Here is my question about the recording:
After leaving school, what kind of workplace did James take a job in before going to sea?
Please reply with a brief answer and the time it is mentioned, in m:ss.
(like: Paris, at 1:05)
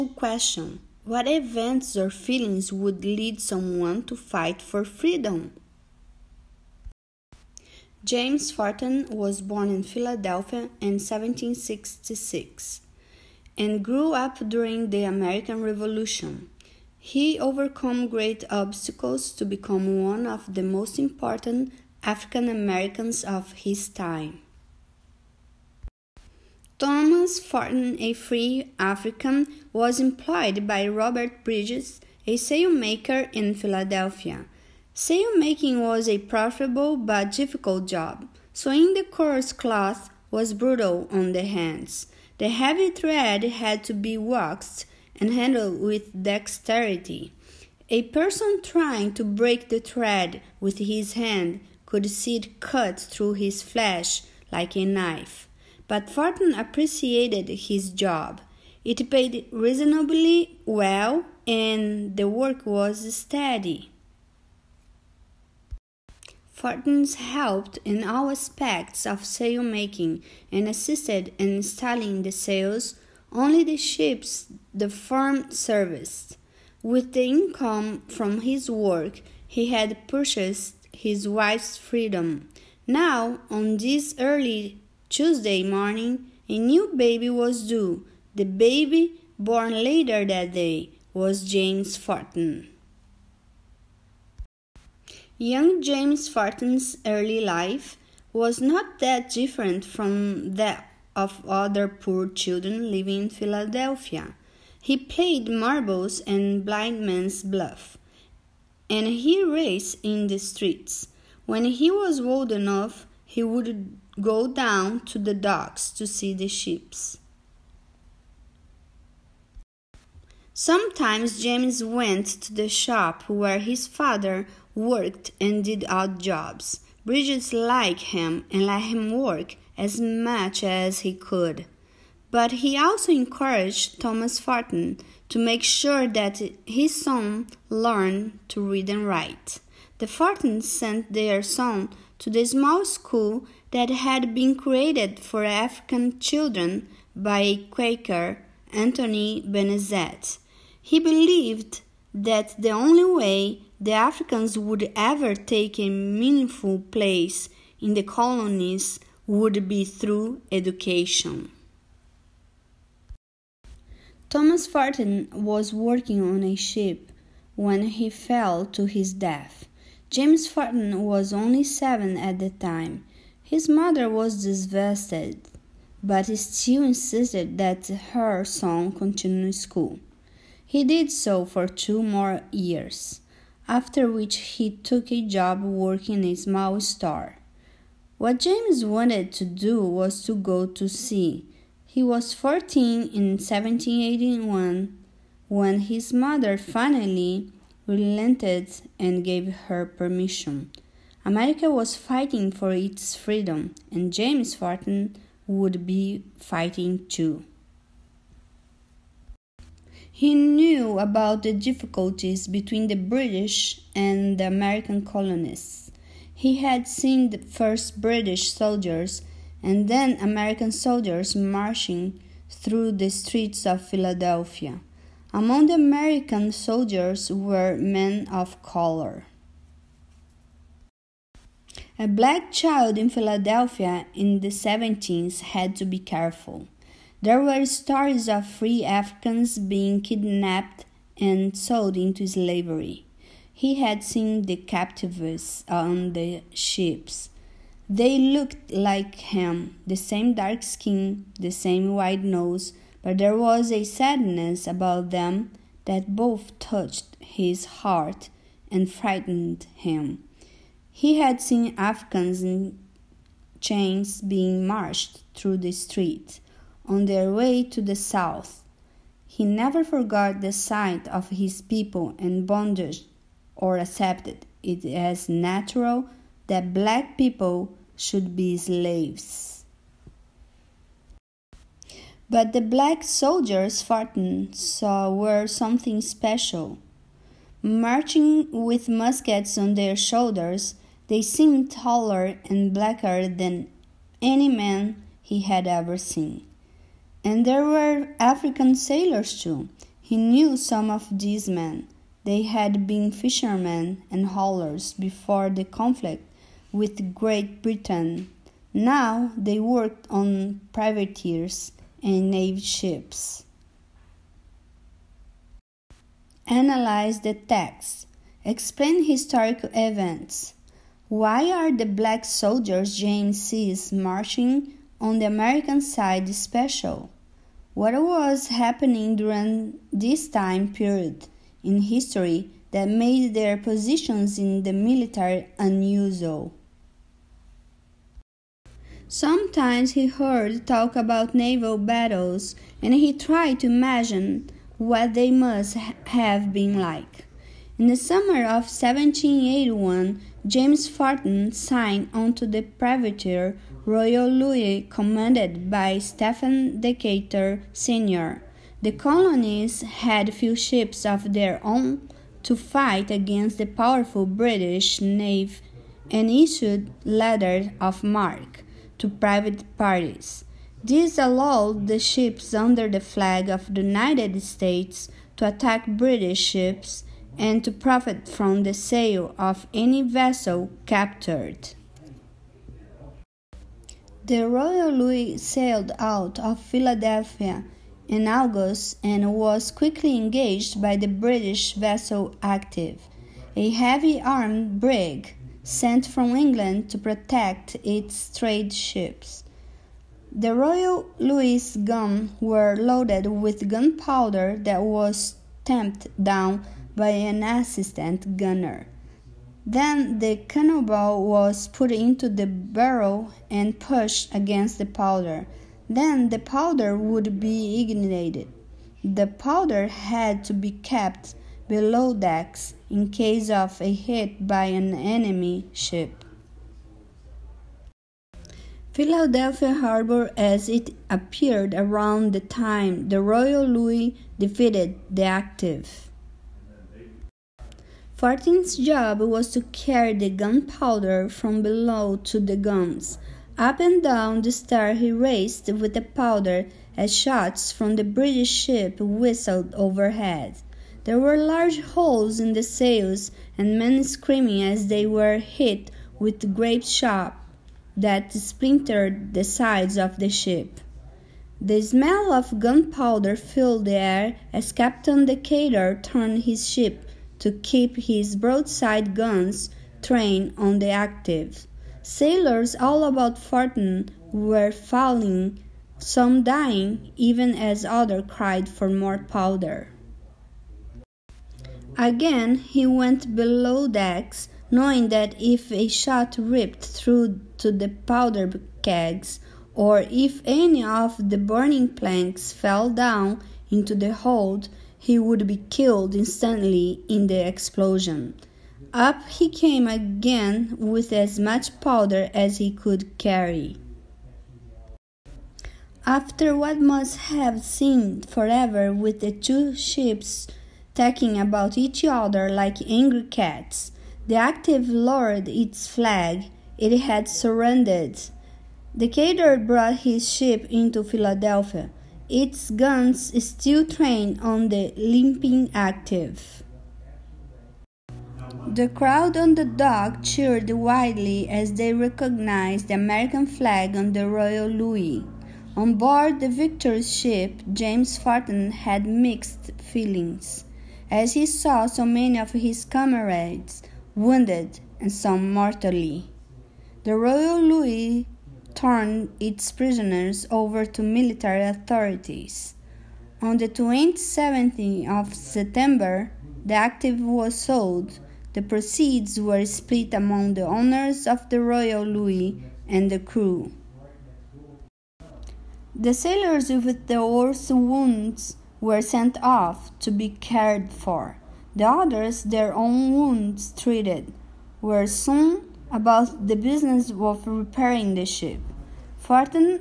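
A small store, at 3:06.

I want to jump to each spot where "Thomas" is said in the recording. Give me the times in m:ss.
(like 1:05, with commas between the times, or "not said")
0:26, 2:14, 2:44.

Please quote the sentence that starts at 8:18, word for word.
Up he came again with as much powder as he could carry.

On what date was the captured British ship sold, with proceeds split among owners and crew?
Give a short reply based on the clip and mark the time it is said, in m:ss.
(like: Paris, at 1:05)
September 27, at 9:13.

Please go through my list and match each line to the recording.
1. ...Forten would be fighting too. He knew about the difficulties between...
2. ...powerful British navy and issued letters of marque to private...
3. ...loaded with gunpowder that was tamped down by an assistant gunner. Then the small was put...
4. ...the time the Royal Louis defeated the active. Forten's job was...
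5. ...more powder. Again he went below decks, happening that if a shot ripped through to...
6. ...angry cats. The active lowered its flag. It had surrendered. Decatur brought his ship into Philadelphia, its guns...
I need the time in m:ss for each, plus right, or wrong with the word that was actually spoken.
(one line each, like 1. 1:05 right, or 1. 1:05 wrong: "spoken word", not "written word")
1. 3:24 right
2. 6:03 right
3. 6:42 wrong: "cannonball", not "small"
4. 7:12 right
5. 7:58 wrong: "knowing", not "happening"
6. 8:32 right.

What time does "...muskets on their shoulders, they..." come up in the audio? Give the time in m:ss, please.
4:48.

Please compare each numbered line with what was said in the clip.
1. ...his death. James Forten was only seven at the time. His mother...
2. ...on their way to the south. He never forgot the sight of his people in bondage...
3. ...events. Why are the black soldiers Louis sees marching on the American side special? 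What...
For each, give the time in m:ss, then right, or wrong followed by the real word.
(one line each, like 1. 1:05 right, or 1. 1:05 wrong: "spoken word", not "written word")
1. 2:48 right
2. 4:26 right
3. 5:19 wrong: "James", not "Louis".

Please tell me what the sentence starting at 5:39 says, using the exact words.
Sometimes he heard talk about naval battles, and he tried to imagine what they must have been like.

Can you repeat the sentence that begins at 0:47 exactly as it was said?
A person trying to break the thread with his hand could see it cut through his flesh like a knife.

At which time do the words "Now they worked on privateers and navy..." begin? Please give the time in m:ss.
5:08.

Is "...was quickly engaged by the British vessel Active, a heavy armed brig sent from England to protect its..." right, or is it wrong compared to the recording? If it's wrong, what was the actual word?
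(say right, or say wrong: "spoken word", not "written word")
right.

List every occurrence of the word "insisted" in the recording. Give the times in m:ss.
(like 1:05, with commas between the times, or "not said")
2:56.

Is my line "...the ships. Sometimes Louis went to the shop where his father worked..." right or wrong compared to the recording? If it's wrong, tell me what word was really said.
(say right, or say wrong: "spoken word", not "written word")
wrong: "James", not "Louis".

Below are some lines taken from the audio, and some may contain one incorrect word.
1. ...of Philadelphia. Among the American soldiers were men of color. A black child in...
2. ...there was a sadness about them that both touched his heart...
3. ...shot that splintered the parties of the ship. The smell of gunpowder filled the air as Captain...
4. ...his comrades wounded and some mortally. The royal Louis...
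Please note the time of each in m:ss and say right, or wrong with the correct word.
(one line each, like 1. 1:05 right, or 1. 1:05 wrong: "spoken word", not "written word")
1. 3:43 right
2. 4:13 right
3. 7:36 wrong: "sides", not "parties"
4. 9:02 right.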